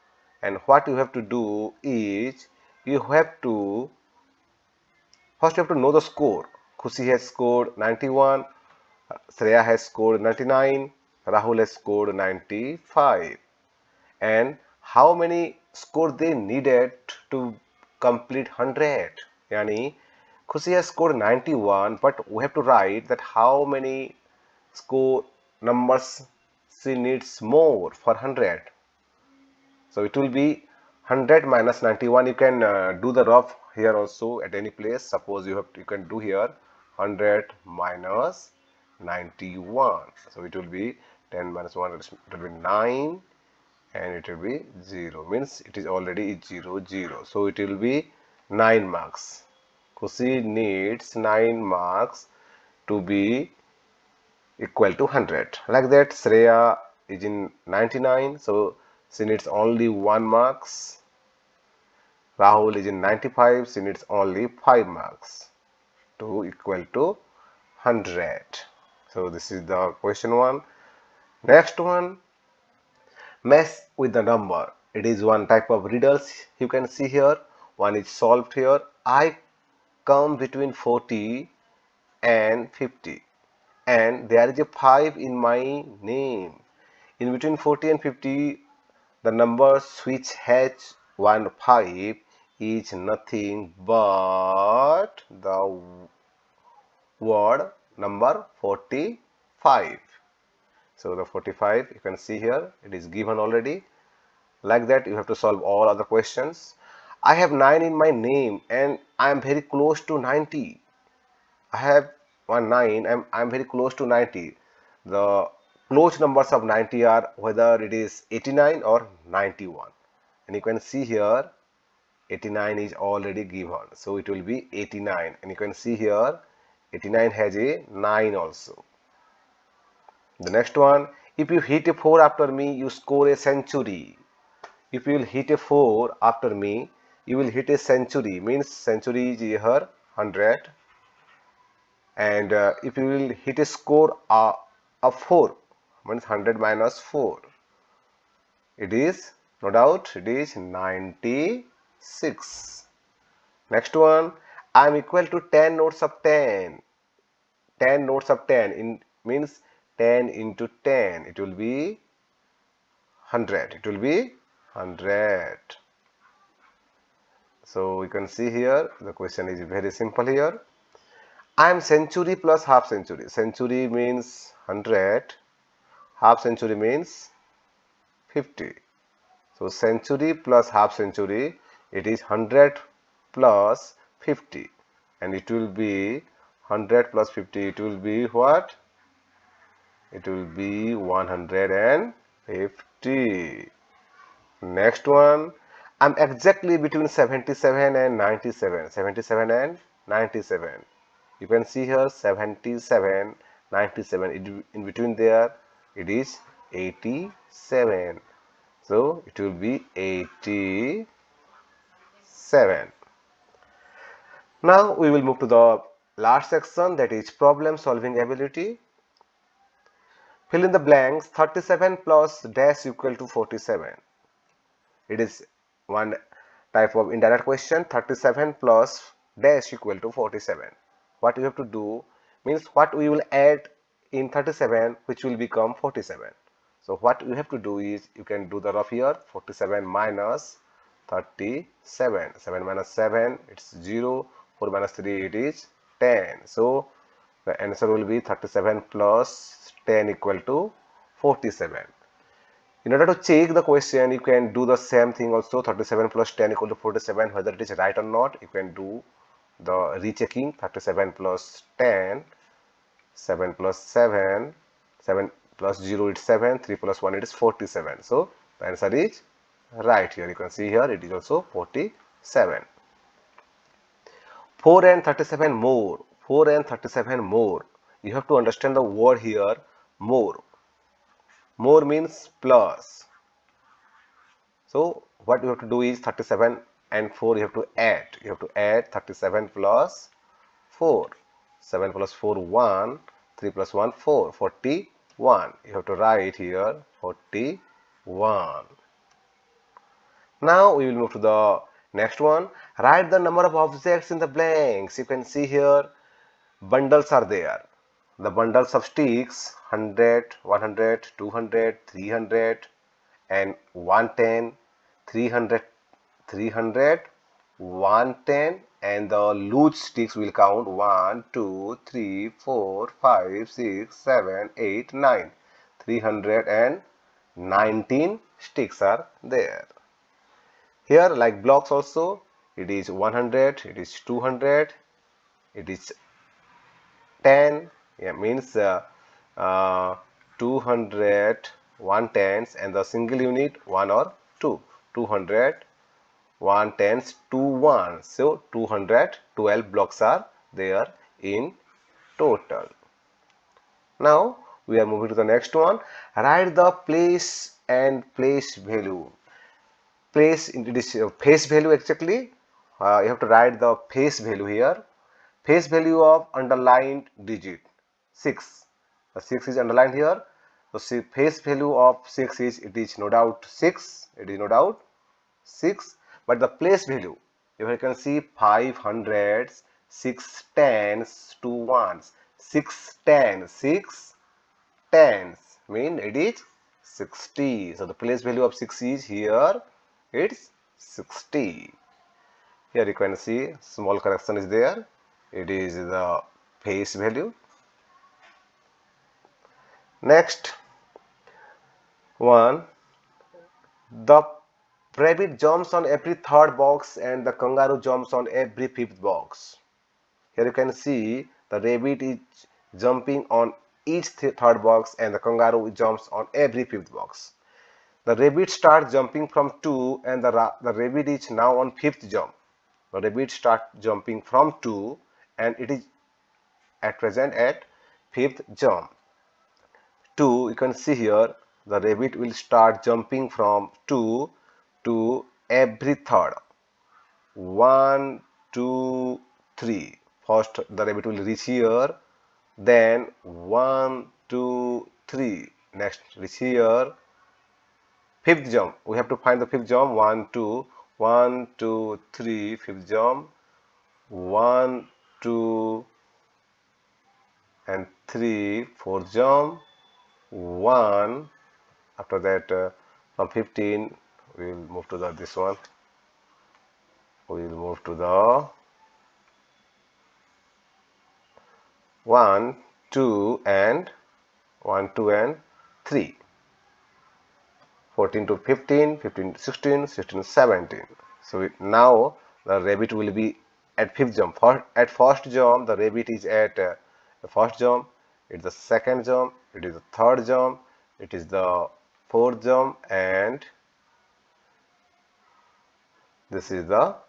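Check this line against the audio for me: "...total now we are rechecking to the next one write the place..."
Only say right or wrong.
wrong.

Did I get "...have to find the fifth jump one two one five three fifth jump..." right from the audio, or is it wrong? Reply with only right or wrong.
wrong.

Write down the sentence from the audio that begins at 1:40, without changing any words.
So the 45 you can see here it is given already.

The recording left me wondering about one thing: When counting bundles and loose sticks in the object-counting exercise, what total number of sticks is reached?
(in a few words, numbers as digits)
319.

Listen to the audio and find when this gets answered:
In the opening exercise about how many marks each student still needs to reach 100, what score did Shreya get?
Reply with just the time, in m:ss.
0:09.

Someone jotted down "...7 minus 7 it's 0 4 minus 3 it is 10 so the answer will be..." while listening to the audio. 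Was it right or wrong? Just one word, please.
right.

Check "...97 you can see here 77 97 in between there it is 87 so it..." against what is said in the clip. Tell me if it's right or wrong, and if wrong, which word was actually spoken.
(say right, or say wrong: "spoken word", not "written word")
right.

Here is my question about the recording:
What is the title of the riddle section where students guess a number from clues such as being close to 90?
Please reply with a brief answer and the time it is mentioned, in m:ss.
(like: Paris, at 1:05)
Mess with the number, at 1:13.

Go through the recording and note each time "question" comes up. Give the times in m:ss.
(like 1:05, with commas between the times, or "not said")
1:10, 1:46, 2:49, 3:47, 4:13.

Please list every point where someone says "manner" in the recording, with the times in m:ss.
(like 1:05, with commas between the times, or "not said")
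not said.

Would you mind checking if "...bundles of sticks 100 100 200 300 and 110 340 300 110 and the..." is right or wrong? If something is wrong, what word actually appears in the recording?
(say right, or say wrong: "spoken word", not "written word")
wrong: "300", not "340".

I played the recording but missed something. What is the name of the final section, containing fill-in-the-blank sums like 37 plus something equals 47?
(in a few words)
Problem solving ability.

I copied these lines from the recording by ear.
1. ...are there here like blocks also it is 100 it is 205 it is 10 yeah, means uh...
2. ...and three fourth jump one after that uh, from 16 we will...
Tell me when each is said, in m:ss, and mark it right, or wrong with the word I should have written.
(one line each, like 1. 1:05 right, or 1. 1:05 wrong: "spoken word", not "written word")
1. 5:28 wrong: "200", not "205"
2. 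7:37 wrong: "15", not "16".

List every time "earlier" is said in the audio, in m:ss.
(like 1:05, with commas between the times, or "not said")
not said.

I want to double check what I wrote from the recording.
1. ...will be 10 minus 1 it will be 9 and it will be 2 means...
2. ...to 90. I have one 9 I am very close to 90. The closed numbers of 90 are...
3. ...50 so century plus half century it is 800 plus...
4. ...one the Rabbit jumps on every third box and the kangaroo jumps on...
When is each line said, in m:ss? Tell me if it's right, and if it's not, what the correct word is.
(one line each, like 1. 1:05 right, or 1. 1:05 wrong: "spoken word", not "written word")
1. 0:40 wrong: "0", not "2"
2. 1:50 right
3. 2:58 wrong: "100", not "800"
4. 6:42 right.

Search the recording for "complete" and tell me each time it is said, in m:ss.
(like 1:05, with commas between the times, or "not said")
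0:18.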